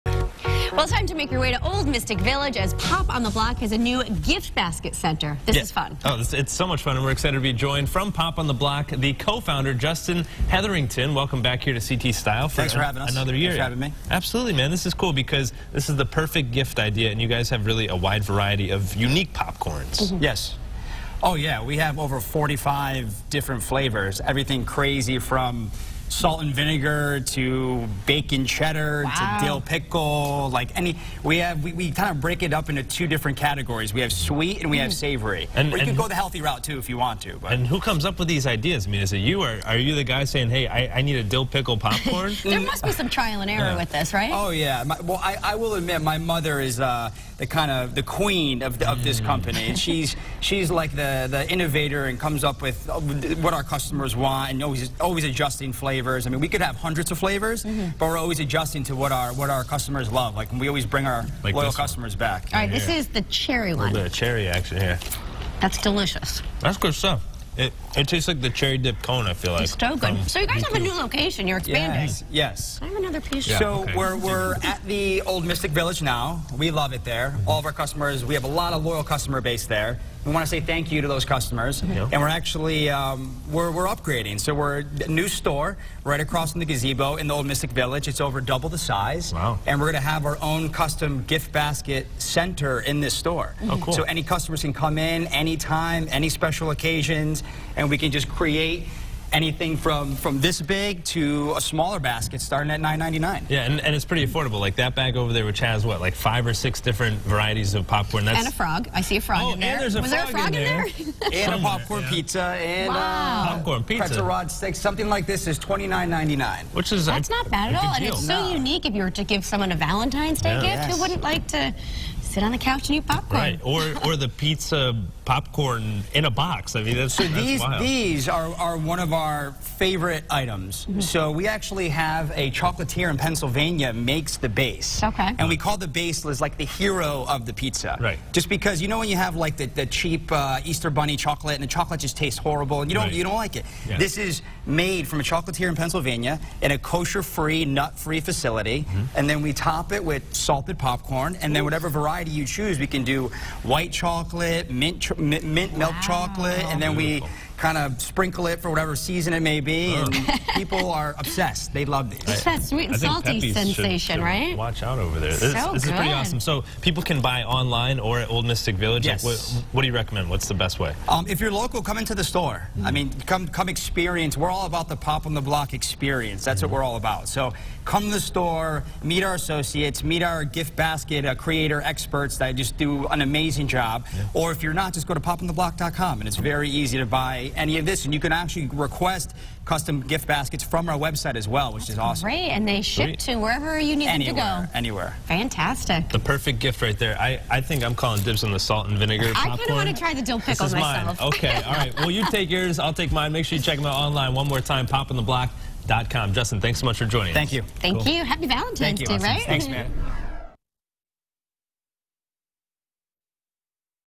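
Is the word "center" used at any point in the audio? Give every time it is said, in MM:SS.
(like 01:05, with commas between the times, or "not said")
00:04, 01:32.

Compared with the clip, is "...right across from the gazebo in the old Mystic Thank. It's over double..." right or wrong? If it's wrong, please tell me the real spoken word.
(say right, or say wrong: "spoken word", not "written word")
wrong: "Village", not "Thank".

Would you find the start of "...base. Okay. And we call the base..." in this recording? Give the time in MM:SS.
02:14.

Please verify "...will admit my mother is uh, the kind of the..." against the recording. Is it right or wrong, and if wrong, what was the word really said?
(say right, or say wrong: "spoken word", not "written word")
right.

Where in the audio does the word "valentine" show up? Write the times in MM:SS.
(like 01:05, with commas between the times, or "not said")
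01:59, 03:28.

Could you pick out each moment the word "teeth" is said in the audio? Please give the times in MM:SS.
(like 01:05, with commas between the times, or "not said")
not said.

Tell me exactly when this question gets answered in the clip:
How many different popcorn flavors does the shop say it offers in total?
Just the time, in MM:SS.
00:22.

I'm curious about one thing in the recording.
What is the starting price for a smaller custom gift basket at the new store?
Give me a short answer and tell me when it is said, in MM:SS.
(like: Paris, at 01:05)
$9.99, at 01:42.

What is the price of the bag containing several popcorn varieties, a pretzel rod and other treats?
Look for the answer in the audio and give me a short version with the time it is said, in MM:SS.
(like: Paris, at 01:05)
$29.99, at 01:55.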